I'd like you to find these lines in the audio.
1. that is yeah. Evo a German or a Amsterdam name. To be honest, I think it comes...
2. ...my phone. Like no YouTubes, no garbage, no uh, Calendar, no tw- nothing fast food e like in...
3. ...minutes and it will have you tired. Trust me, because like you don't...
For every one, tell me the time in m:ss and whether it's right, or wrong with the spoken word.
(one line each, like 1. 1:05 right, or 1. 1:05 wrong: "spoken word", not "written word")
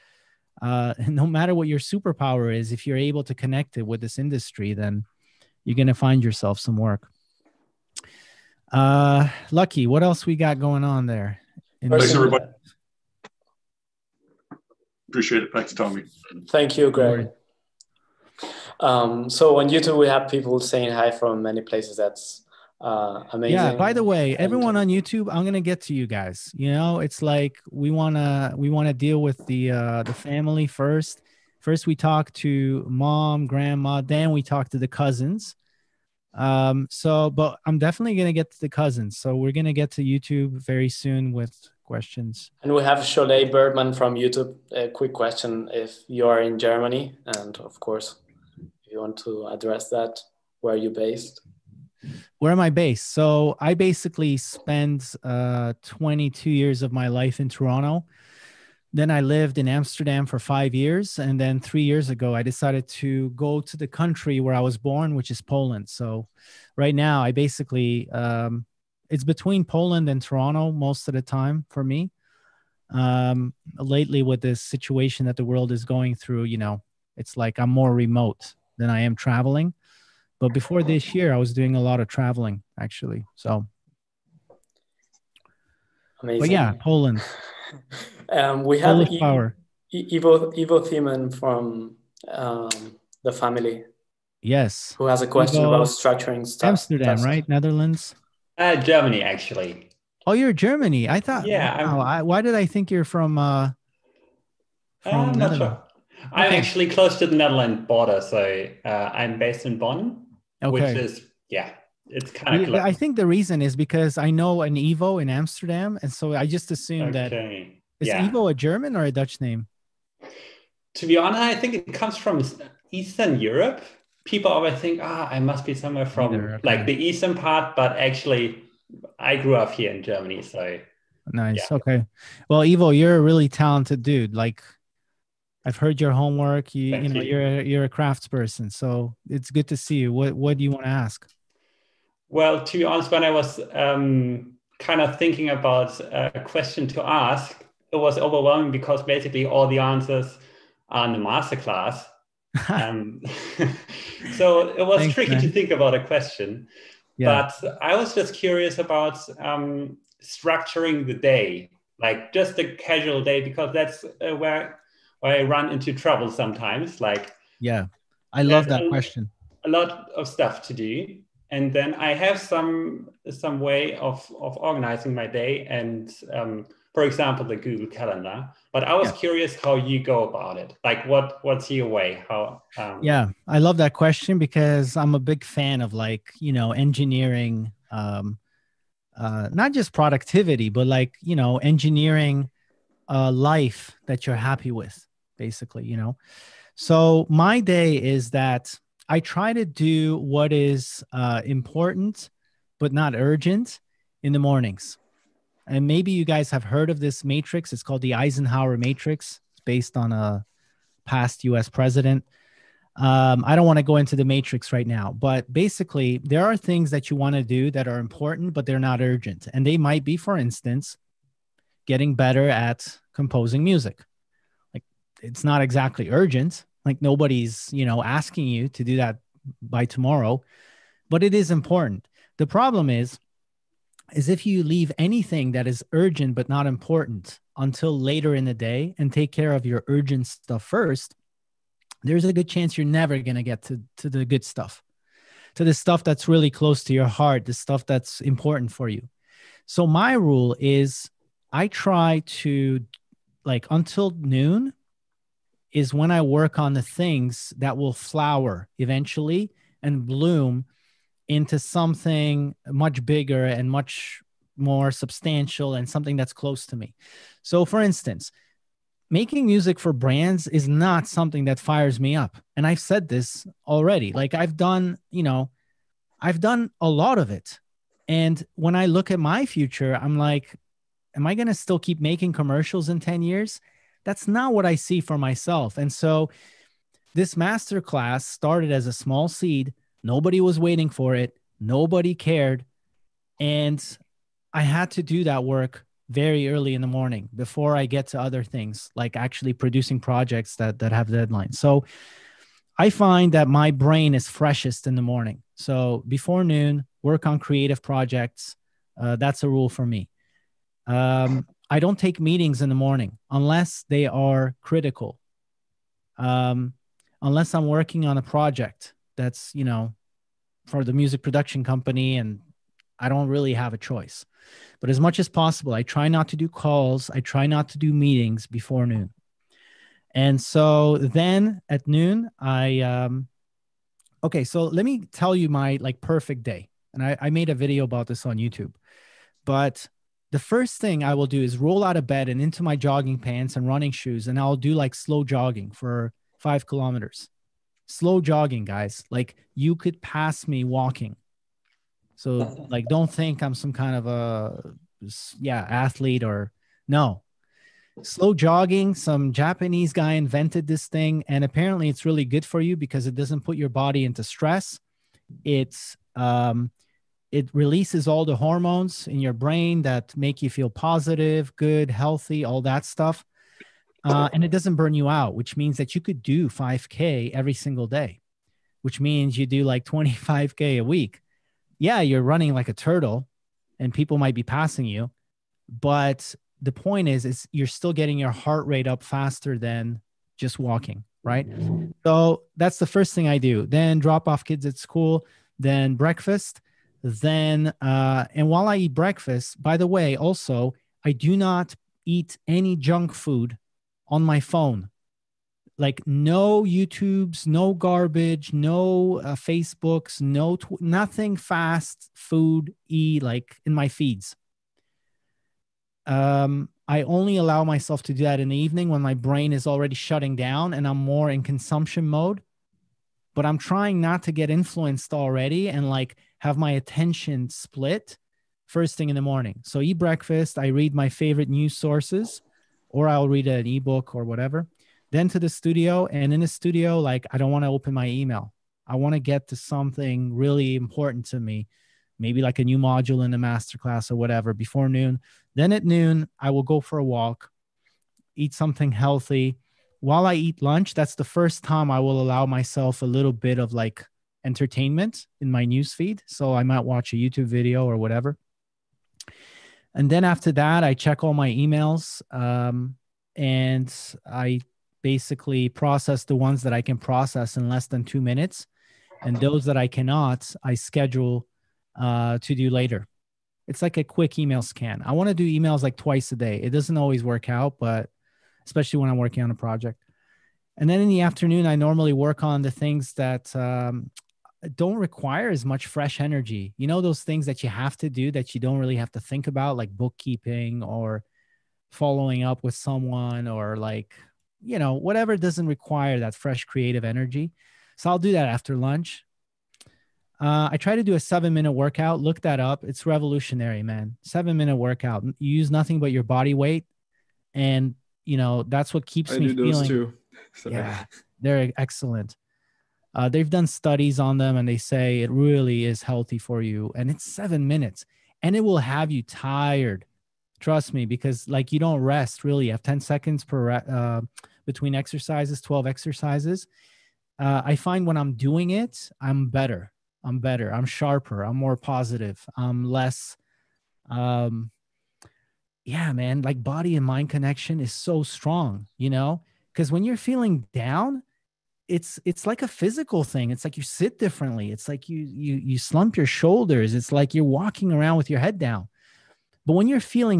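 1. 1:58 wrong: "Dutch", not "Amsterdam"
2. 6:44 wrong: "Facebooks", not "Calendar"
3. 8:37 right.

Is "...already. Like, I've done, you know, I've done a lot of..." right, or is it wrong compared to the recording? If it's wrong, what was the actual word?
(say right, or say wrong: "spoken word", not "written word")
right.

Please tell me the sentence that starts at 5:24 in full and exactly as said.
But as much as possible, I try not to do calls, I try not to do meetings before noon.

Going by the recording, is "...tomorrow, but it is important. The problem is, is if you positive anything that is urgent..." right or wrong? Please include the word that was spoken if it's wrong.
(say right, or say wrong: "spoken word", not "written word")
wrong: "leave", not "positive".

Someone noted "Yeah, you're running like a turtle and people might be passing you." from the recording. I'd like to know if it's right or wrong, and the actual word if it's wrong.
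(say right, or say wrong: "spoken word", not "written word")
right.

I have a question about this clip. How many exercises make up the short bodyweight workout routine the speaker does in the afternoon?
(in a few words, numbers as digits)
12.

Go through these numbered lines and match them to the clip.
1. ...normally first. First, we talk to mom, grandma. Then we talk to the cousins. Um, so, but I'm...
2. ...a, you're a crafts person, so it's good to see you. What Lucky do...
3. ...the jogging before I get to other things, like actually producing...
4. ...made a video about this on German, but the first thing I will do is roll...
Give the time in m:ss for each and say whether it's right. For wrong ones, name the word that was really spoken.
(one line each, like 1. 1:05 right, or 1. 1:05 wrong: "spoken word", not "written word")
1. 0:30 wrong: "family", not "normally"
2. 2:17 wrong: "What", not "Lucky"
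3. 4:56 wrong: "morning", not "jogging"
4. 5:37 wrong: "YouTube", not "German".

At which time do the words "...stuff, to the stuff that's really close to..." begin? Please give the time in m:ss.
4:04.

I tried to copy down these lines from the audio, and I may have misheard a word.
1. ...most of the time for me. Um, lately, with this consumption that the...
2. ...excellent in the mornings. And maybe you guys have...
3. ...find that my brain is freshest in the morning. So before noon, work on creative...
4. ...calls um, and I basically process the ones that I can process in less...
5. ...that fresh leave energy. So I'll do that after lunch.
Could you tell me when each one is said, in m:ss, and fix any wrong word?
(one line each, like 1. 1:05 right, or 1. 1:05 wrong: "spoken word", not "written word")
1. 1:10 wrong: "situation", not "consumption"
2. 3:23 wrong: "urgent", not "excellent"
3. 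5:02 right
4. 7:41 wrong: "emails", not "calls"
5. 8:16 wrong: "creative", not "leave".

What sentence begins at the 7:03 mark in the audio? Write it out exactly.
But I'm trying not to get influenced already and like have my attention split first thing in the morning.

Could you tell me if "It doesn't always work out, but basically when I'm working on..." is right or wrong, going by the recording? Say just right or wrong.
wrong.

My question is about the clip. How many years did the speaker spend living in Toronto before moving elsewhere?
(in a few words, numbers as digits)
22.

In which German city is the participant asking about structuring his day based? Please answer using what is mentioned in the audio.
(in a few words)
Bonn.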